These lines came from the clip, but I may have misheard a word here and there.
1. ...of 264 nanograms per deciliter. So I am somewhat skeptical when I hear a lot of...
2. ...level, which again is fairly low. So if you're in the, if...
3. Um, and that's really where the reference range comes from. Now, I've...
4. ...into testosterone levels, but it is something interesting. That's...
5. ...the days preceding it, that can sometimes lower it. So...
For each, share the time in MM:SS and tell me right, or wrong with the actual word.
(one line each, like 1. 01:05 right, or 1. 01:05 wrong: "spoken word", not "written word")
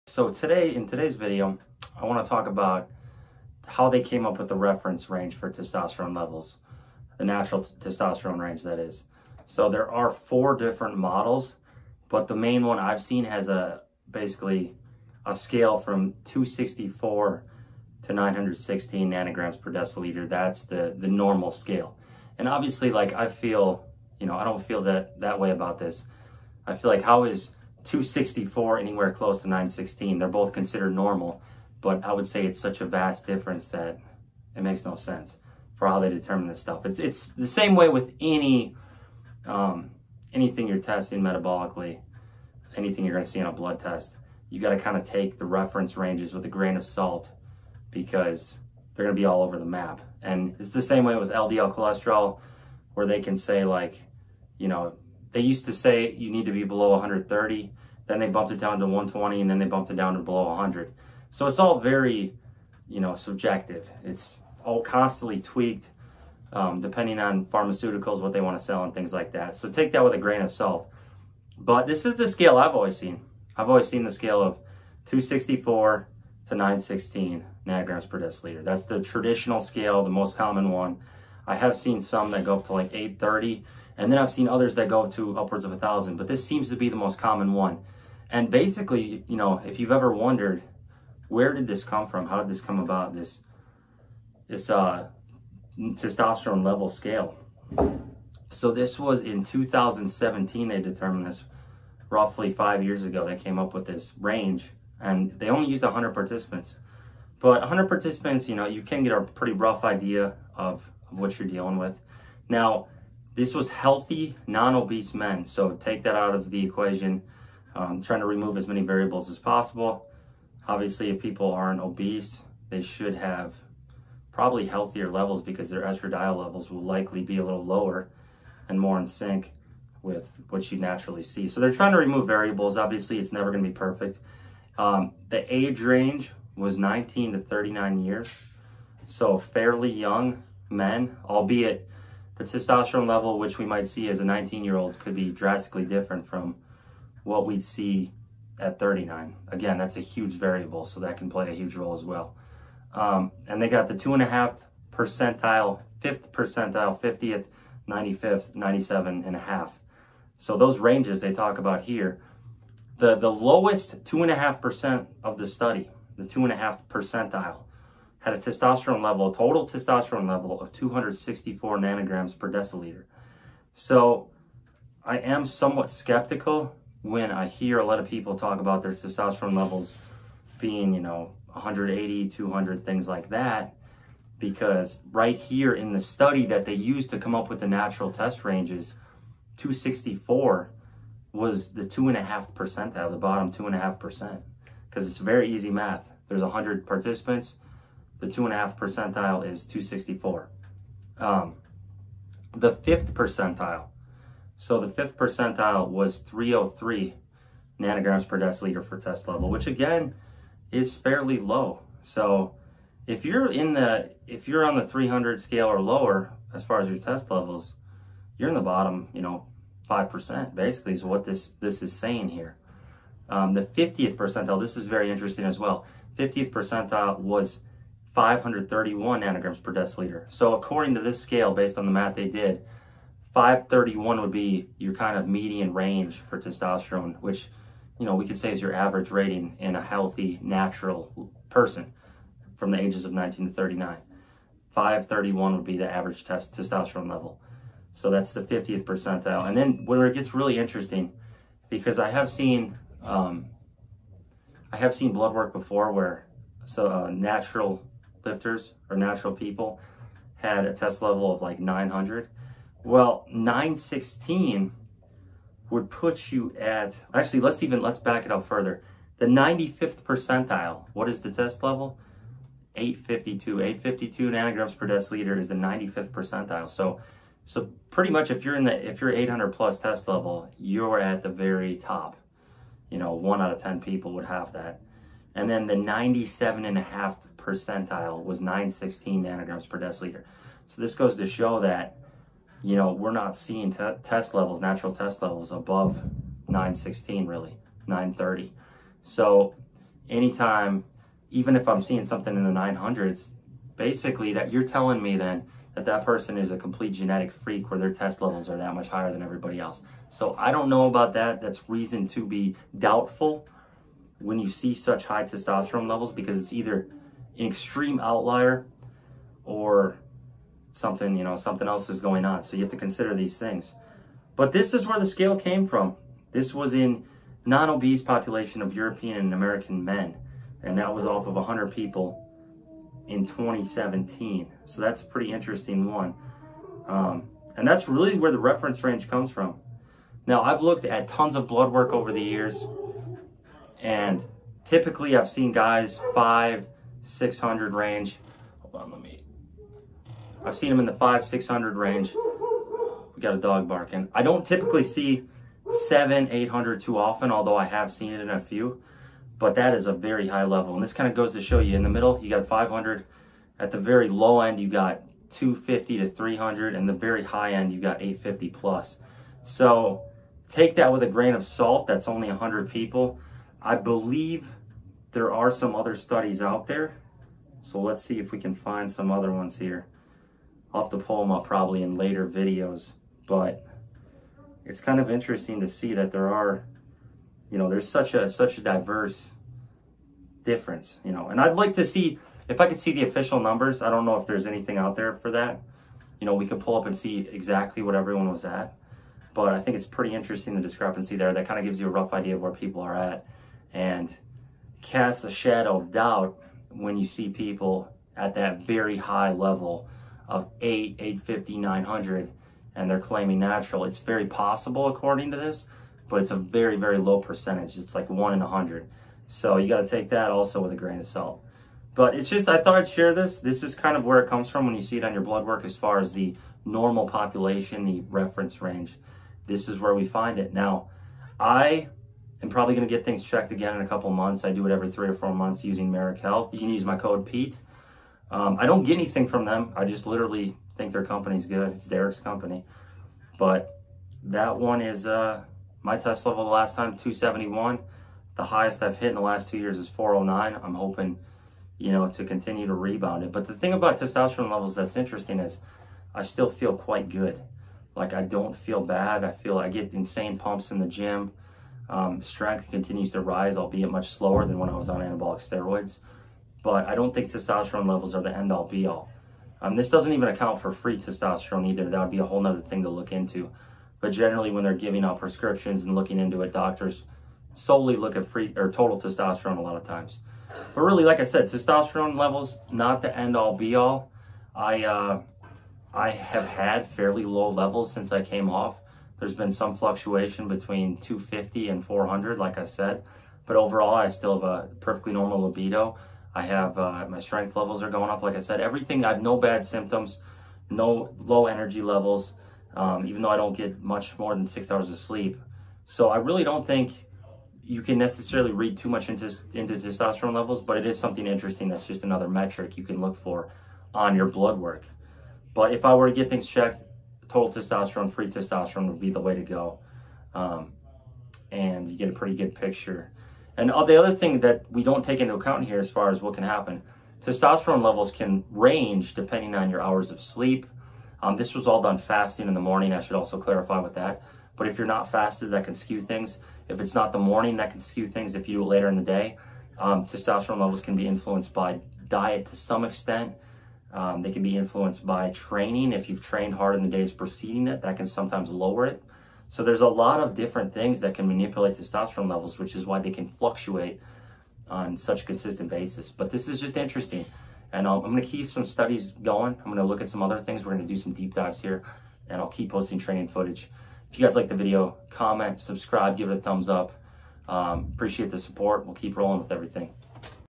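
1. 02:50 right
2. 03:29 right
3. 05:36 right
4. 08:29 right
5. 09:06 right.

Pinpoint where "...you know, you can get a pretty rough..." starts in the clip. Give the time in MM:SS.
01:48.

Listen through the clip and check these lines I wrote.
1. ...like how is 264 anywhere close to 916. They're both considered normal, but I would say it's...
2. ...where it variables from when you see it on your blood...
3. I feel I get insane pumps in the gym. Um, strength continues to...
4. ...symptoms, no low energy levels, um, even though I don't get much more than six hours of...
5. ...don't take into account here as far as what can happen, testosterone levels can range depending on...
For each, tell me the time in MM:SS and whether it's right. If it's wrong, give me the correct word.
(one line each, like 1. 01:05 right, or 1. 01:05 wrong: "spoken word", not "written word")
1. 00:26 right
2. 07:04 wrong: "comes", not "variables"
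3. 07:39 right
4. 08:19 right
5. 08:44 right.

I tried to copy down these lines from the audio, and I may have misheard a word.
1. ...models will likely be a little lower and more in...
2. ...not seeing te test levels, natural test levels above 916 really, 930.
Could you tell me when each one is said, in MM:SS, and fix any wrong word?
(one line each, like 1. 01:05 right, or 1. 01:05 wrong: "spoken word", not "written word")
1. 02:06 wrong: "levels", not "models"
2. 04:53 right.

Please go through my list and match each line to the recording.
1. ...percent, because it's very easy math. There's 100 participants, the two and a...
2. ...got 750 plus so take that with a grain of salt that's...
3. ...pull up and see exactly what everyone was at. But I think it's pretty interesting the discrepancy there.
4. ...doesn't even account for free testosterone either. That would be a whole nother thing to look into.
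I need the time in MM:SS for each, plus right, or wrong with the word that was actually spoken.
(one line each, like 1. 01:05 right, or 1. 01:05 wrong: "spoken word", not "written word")
1. 03:13 right
2. 06:07 wrong: "850", not "750"
3. 06:36 right
4. 07:49 right.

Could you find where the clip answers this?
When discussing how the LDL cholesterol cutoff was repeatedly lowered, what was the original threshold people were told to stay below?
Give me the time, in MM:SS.
00:56.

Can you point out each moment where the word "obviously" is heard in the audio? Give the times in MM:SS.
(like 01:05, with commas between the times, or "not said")
00:22, 02:00, 02:12.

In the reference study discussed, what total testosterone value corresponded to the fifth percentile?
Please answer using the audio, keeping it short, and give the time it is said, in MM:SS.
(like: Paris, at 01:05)
303 ng/dL, at 03:26.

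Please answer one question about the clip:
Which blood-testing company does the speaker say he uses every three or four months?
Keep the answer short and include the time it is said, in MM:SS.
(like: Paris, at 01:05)
Marek Health, at 07:15.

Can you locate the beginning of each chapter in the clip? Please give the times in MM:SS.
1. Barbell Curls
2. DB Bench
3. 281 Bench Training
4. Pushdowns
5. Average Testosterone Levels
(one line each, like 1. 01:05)
1. 05:20
2. 01:57
3. 00:23
4. 03:37
5. 03:47.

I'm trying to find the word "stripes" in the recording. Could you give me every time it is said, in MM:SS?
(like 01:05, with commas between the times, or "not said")
not said.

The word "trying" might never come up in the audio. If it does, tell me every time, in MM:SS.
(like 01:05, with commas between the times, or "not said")
01:58, 02:11.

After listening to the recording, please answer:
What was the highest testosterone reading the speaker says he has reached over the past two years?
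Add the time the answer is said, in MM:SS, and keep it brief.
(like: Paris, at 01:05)
409, at 07:29.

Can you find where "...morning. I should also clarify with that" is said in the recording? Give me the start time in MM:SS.
08:52.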